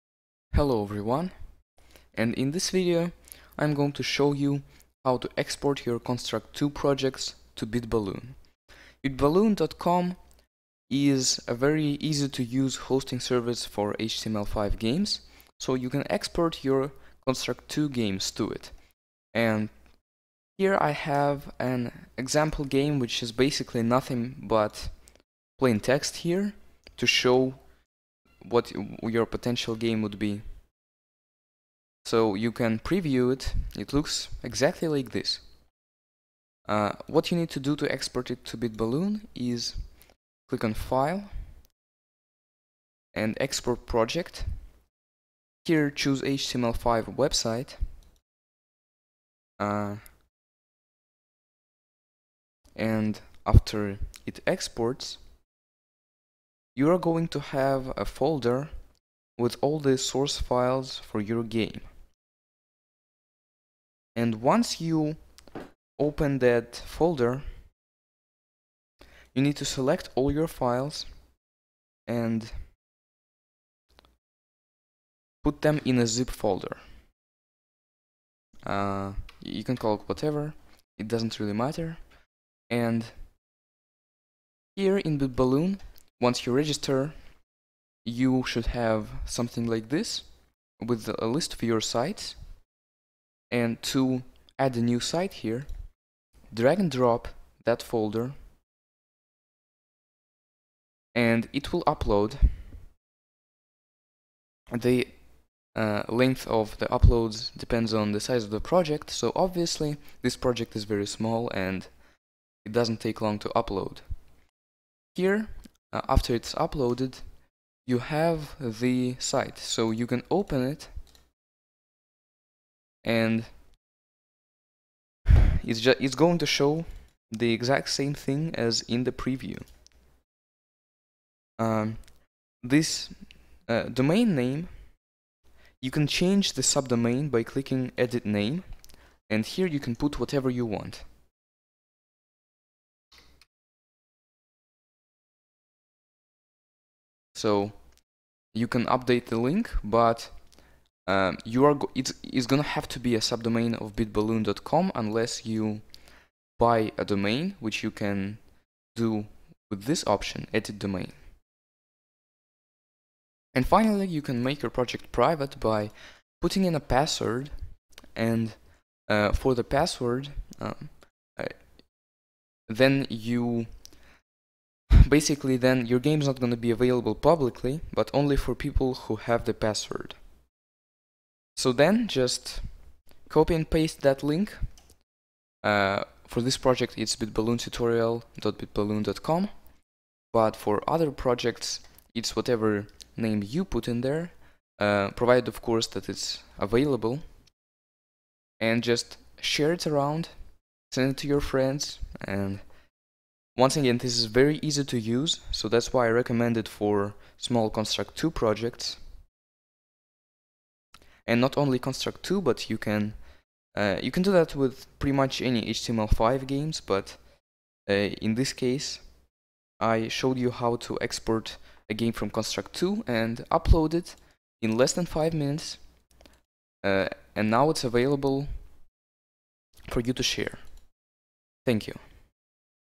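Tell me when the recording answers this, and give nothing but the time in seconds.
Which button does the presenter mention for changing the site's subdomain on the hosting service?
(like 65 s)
137 s.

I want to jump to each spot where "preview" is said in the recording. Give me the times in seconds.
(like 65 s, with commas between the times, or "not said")
32 s, 129 s.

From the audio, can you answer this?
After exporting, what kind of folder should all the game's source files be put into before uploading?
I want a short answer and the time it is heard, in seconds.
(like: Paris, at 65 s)
zip folder, at 76 s.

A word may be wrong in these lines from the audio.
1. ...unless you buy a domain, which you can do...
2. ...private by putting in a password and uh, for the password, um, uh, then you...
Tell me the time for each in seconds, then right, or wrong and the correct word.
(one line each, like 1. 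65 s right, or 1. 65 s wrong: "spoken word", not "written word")
1. 154 s right
2. 165 s right.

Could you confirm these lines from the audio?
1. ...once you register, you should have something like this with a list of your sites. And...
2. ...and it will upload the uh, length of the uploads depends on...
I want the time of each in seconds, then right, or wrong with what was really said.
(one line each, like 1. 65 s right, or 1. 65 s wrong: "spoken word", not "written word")
1. 86 s right
2. 101 s right.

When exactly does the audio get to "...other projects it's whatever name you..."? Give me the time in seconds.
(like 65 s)
190 s.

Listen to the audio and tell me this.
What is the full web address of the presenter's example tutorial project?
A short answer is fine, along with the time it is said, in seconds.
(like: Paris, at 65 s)
bitballoontutorial.bitballoon.com, at 187 s.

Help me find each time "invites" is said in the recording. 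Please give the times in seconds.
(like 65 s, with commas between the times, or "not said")
not said.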